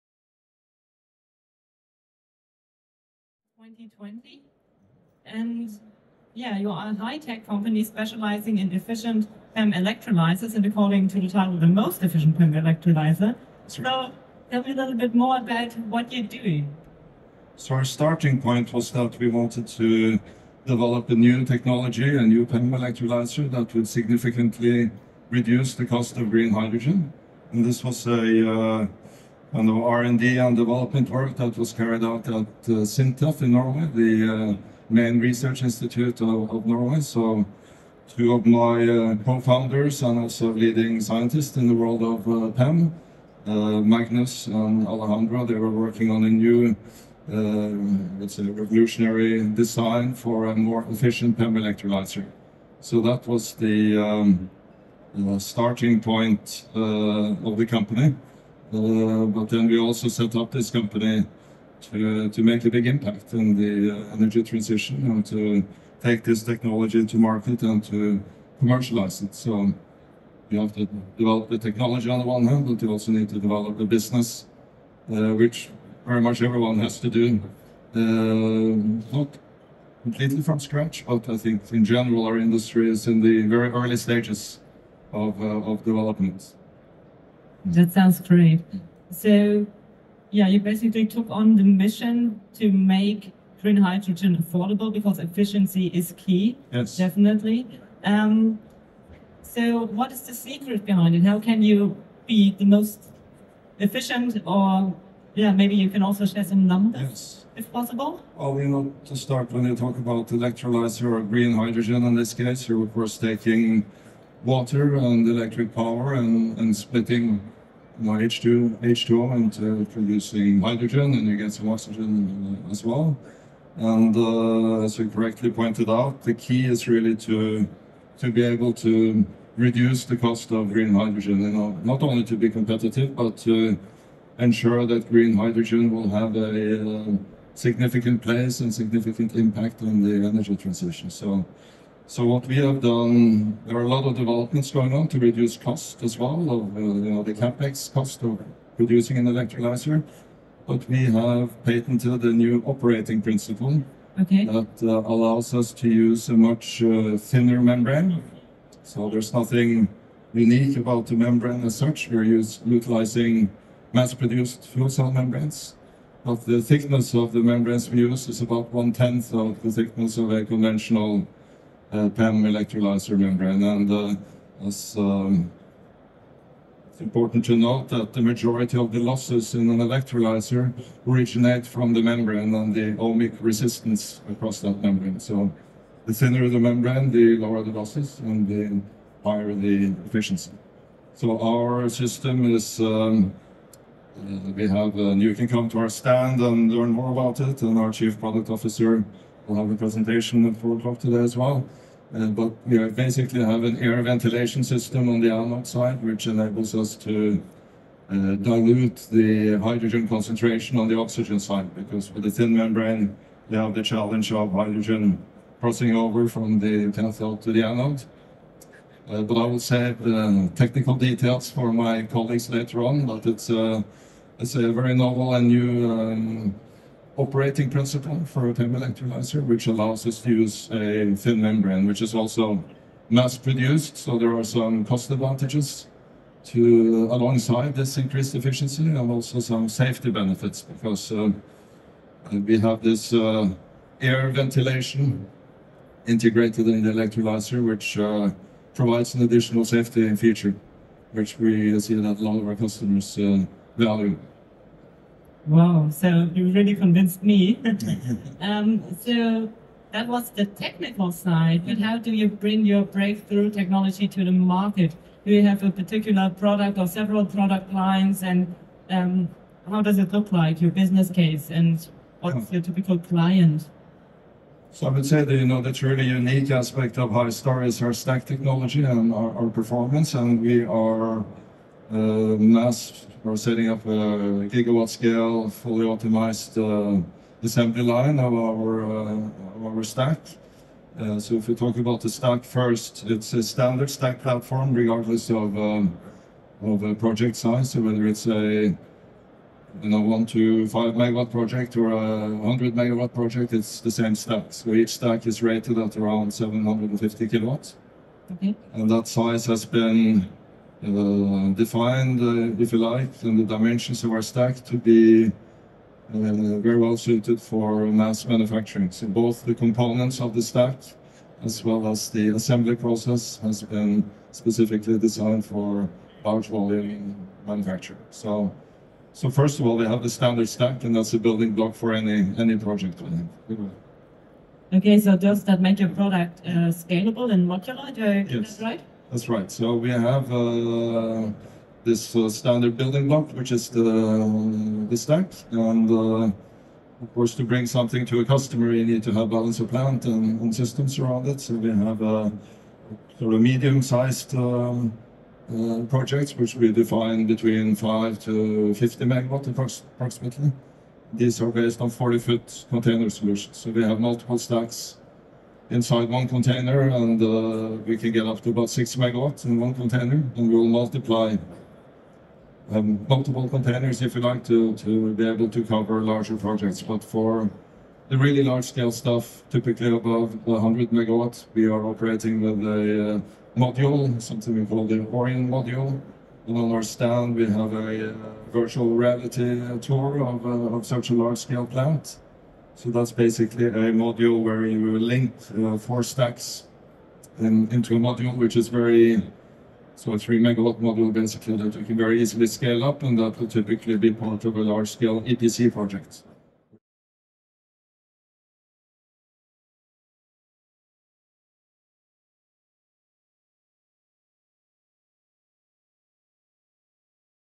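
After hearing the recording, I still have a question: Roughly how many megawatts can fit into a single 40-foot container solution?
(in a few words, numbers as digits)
6 megawatts.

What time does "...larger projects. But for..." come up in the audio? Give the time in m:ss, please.
6:16.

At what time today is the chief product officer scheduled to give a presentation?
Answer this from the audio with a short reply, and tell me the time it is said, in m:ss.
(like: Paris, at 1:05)
4 o'clock, at 3:20.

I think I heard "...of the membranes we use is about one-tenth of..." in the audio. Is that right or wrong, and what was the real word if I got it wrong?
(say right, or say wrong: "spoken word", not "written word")
right.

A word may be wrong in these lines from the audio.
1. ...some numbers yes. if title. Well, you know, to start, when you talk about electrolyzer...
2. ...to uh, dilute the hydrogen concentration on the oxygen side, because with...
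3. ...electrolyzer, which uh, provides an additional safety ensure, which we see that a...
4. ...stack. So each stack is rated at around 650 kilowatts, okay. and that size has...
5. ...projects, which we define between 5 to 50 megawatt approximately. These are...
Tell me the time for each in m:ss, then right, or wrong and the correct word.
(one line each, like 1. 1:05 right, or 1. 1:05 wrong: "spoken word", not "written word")
1. 1:46 wrong: "possible", not "title"
2. 3:26 right
3. 4:06 wrong: "feature", not "ensure"
4. 5:04 wrong: "750", not "650"
5. 5:55 right.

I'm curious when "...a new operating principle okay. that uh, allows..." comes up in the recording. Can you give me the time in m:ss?
2:32.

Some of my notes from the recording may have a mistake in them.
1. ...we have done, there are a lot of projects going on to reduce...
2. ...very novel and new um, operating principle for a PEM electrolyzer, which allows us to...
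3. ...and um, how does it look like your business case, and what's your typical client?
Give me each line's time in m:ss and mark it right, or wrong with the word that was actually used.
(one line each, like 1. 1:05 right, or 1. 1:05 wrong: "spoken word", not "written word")
1. 2:22 wrong: "developments", not "projects"
2. 3:44 right
3. 4:28 right.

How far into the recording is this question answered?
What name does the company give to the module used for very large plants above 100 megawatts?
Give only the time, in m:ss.
6:25.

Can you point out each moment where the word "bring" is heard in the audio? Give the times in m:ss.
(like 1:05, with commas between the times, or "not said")
4:22, 5:47.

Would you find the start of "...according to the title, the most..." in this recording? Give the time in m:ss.
0:10.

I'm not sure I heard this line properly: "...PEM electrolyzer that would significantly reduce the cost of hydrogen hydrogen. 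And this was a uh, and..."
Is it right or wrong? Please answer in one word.
wrong.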